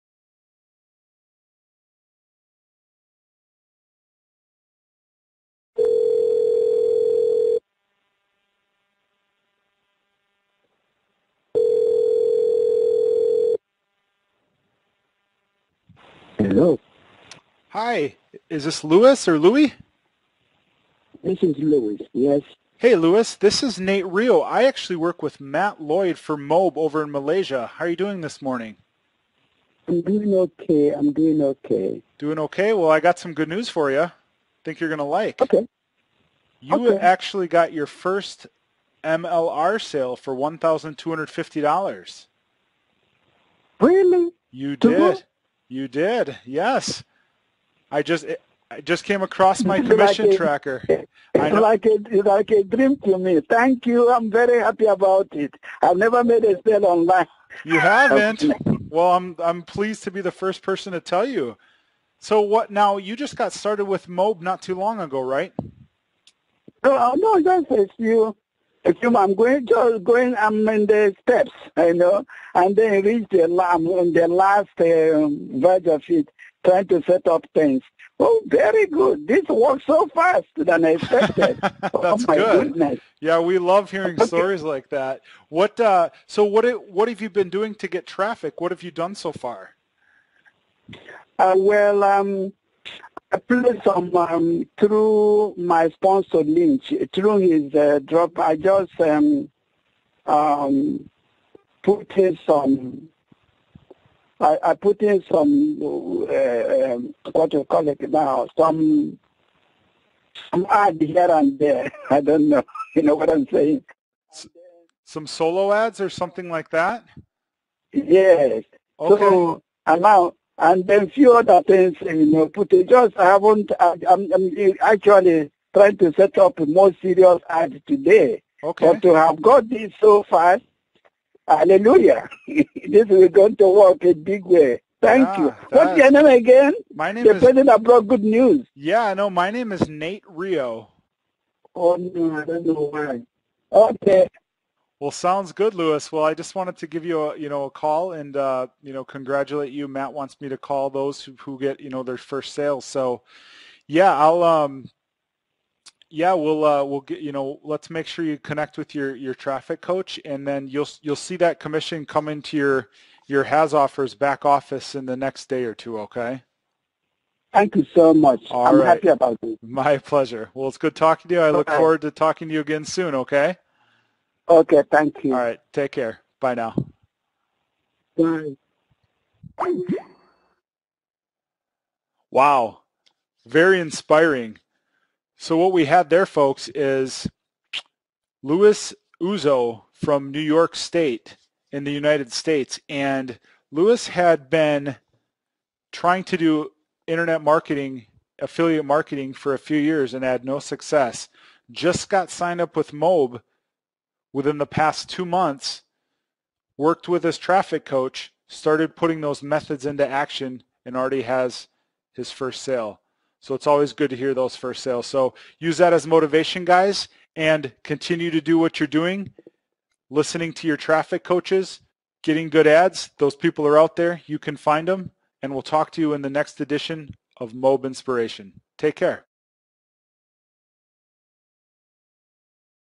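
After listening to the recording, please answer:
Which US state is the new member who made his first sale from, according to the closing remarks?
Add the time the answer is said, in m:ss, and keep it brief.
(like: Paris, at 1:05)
New York, at 3:10.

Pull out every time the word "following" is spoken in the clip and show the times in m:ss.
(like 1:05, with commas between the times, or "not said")
not said.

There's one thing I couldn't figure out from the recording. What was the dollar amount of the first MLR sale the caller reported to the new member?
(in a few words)
$1,250.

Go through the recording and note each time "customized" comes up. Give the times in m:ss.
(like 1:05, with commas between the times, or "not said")
not said.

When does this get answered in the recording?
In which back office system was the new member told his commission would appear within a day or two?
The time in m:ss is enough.
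2:43.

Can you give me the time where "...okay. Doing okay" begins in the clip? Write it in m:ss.
0:31.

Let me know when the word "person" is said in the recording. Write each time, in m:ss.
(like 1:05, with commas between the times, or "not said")
1:00, 2:17.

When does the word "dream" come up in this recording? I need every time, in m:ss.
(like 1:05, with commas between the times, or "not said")
0:52.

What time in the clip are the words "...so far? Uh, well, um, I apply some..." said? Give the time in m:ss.
1:29.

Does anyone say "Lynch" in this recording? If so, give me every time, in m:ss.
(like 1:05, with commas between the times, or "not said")
1:36.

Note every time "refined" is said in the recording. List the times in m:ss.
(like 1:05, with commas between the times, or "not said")
not said.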